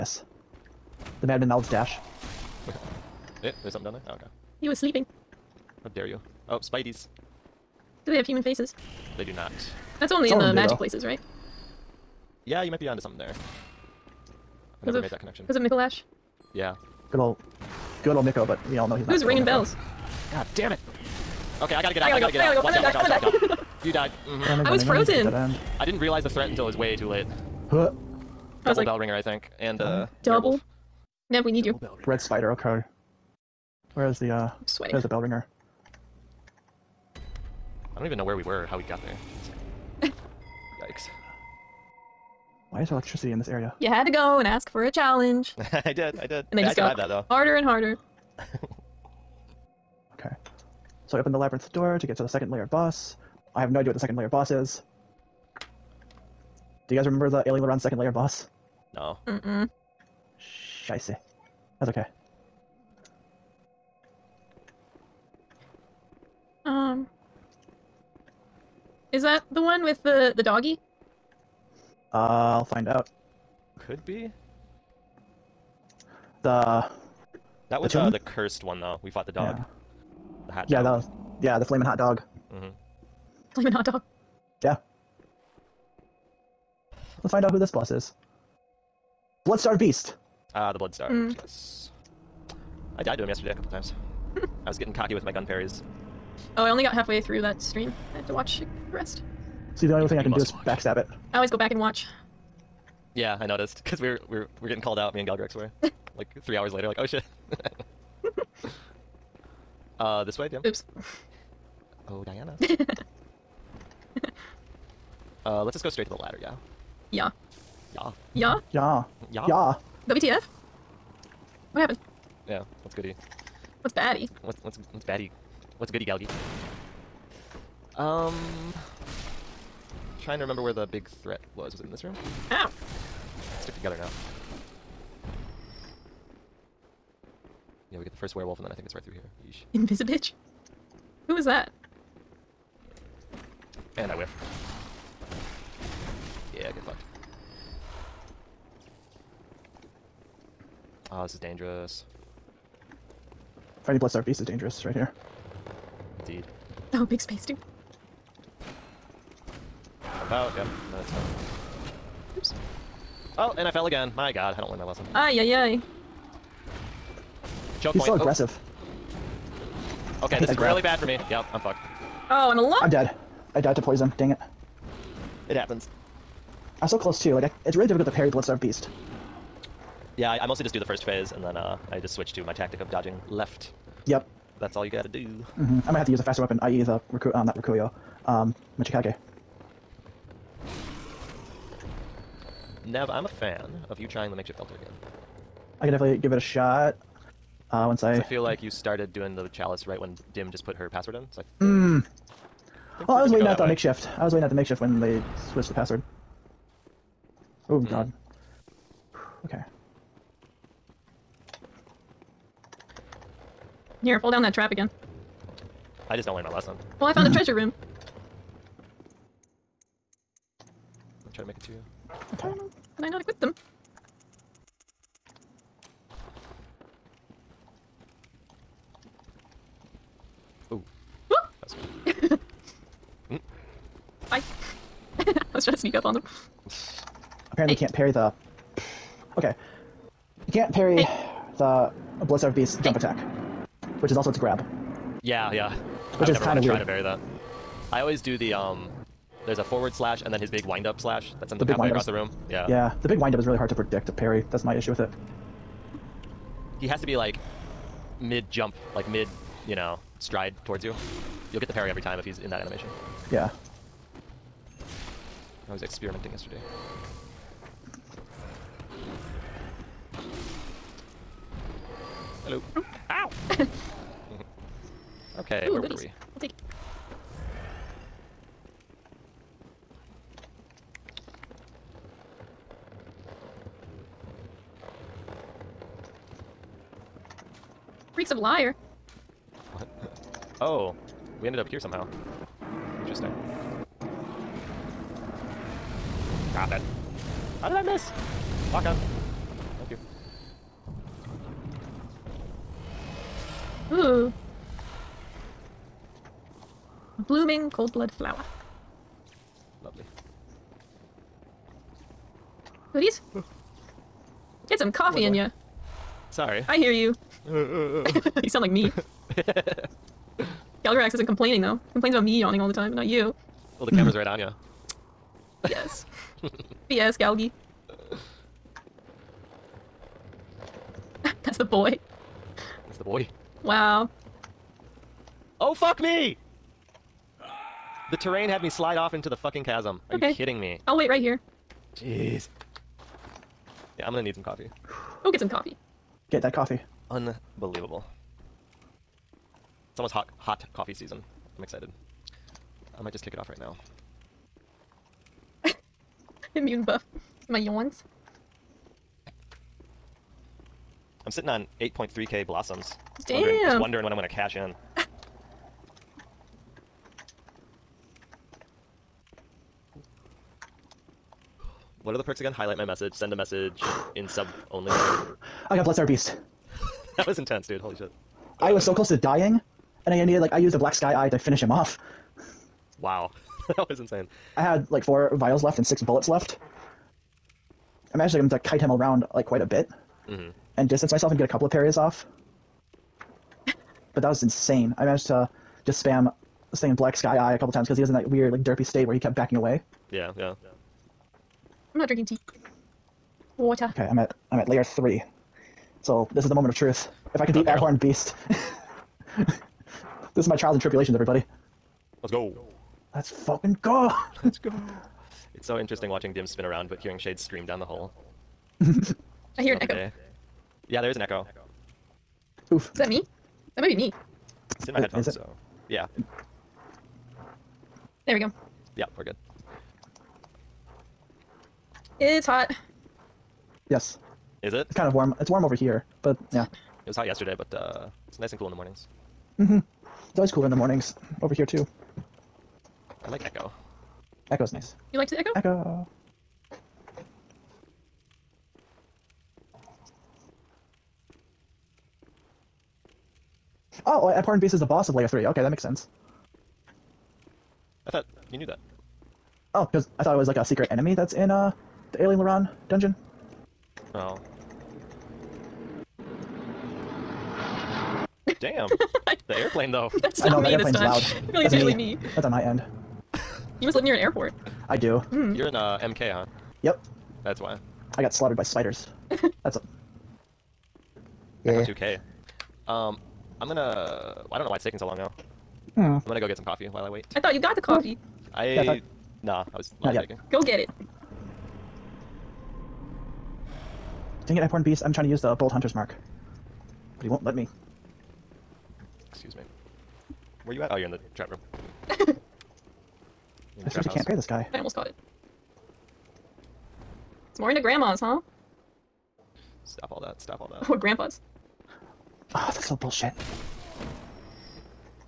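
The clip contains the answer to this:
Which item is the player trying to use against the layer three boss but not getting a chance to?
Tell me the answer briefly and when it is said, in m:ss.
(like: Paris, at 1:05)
Bold Hunter's Mark, at 8:15.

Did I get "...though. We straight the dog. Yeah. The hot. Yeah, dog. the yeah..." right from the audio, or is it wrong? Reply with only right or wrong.
wrong.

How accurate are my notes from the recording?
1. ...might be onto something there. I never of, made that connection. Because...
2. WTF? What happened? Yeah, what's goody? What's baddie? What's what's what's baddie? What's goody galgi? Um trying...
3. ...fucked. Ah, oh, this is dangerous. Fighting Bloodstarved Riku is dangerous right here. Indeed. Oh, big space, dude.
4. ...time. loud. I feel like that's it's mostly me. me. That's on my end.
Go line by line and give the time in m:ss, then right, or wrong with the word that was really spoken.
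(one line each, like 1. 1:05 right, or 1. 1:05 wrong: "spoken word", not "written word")
1. 0:12 right
2. 2:00 right
3. 2:26 wrong: "Beast", not "Riku"
4. 7:50 wrong: "usually", not "mostly".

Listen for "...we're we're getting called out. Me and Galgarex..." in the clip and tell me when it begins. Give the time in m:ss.
1:44.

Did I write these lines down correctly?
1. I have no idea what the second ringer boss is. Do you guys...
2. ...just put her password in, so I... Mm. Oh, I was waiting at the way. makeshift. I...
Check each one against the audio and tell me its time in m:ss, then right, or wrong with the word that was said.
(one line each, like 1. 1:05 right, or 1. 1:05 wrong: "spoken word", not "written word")
1. 0:53 wrong: "layer", not "ringer"
2. 3:20 right.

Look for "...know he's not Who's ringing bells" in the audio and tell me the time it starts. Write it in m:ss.
0:18.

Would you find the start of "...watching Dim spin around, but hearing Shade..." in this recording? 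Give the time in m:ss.
6:56.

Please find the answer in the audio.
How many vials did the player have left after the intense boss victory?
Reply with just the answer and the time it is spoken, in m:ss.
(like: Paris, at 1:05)
4, at 6:25.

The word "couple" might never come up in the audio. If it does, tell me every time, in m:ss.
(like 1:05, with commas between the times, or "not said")
1:33, 6:31, 6:37.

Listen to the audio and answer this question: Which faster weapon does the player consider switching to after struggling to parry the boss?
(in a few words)
Machikage.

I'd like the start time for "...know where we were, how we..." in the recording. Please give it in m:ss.
0:38.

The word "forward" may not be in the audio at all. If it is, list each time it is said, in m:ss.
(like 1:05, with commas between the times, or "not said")
4:09.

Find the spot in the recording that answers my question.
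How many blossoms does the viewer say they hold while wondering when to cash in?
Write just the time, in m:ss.
6:01.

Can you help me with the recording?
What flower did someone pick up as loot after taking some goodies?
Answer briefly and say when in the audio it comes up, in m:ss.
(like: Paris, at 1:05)
blooming cold blood flower, at 5:07.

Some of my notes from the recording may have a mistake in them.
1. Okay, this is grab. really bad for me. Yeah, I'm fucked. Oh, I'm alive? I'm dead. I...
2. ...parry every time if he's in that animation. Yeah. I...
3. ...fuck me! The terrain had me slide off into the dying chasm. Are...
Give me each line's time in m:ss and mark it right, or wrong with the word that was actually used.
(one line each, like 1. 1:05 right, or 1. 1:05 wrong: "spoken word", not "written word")
1. 2:50 right
2. 4:21 right
3. 5:35 wrong: "fucking", not "dying".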